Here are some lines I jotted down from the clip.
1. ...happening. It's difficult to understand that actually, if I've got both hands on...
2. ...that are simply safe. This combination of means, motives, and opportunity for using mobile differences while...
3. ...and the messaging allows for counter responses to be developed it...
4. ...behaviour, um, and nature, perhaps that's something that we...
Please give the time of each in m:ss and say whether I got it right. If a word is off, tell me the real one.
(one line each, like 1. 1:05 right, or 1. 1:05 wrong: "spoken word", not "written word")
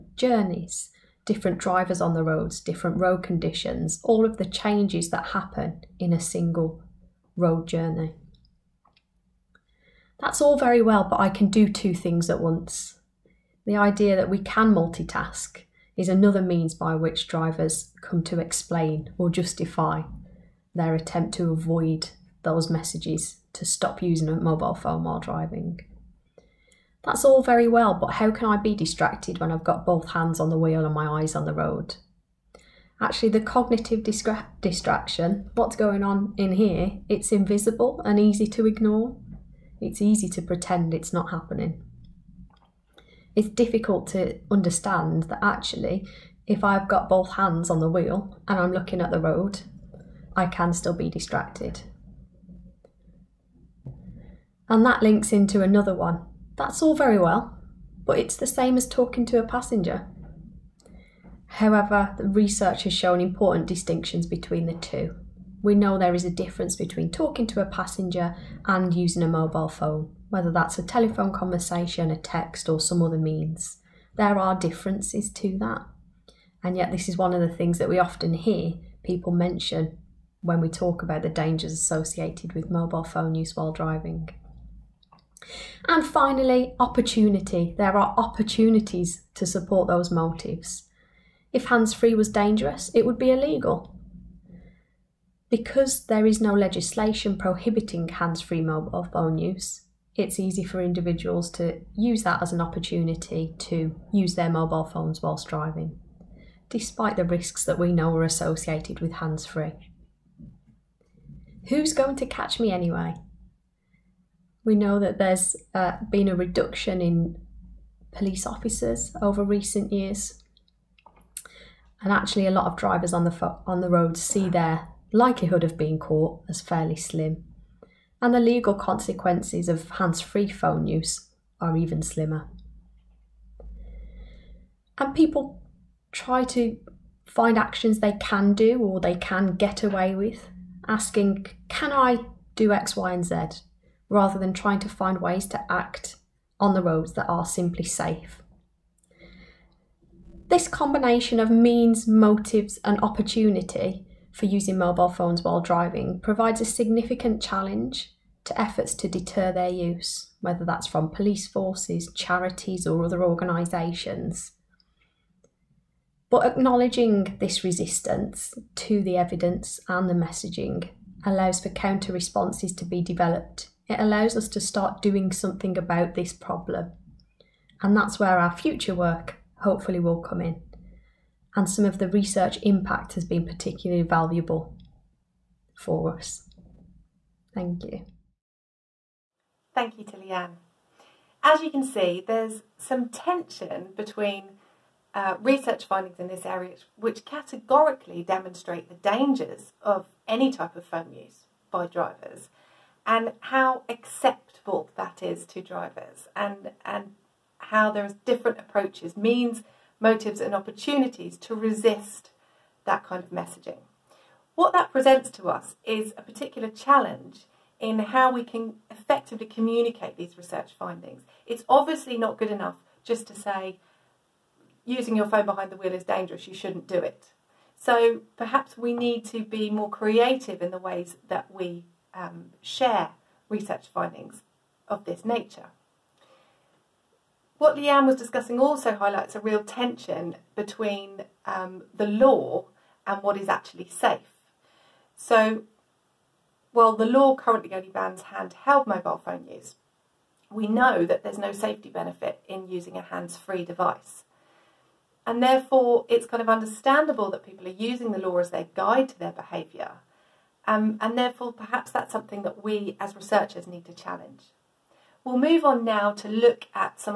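1. 0:41 right
2. 2:27 wrong: "phones", not "differences"
3. 2:49 right
4. 4:19 wrong: "therefore", not "nature".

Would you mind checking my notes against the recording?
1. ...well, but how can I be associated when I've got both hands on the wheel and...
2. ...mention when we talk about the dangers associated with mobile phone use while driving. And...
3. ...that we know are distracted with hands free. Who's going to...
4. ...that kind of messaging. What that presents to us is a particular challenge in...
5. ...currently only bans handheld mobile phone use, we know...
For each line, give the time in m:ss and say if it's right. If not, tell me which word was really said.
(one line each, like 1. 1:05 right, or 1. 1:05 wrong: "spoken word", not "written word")
1. 0:27 wrong: "distracted", not "associated"
2. 1:19 right
3. 1:47 wrong: "associated", not "distracted"
4. 3:32 right
5. 4:07 right.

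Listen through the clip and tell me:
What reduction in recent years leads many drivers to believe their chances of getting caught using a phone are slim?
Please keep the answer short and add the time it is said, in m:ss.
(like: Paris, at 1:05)
police officers, at 1:58.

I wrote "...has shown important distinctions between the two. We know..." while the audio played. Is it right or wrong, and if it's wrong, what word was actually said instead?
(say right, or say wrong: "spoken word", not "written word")
right.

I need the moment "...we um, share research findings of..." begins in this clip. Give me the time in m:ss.
3:51.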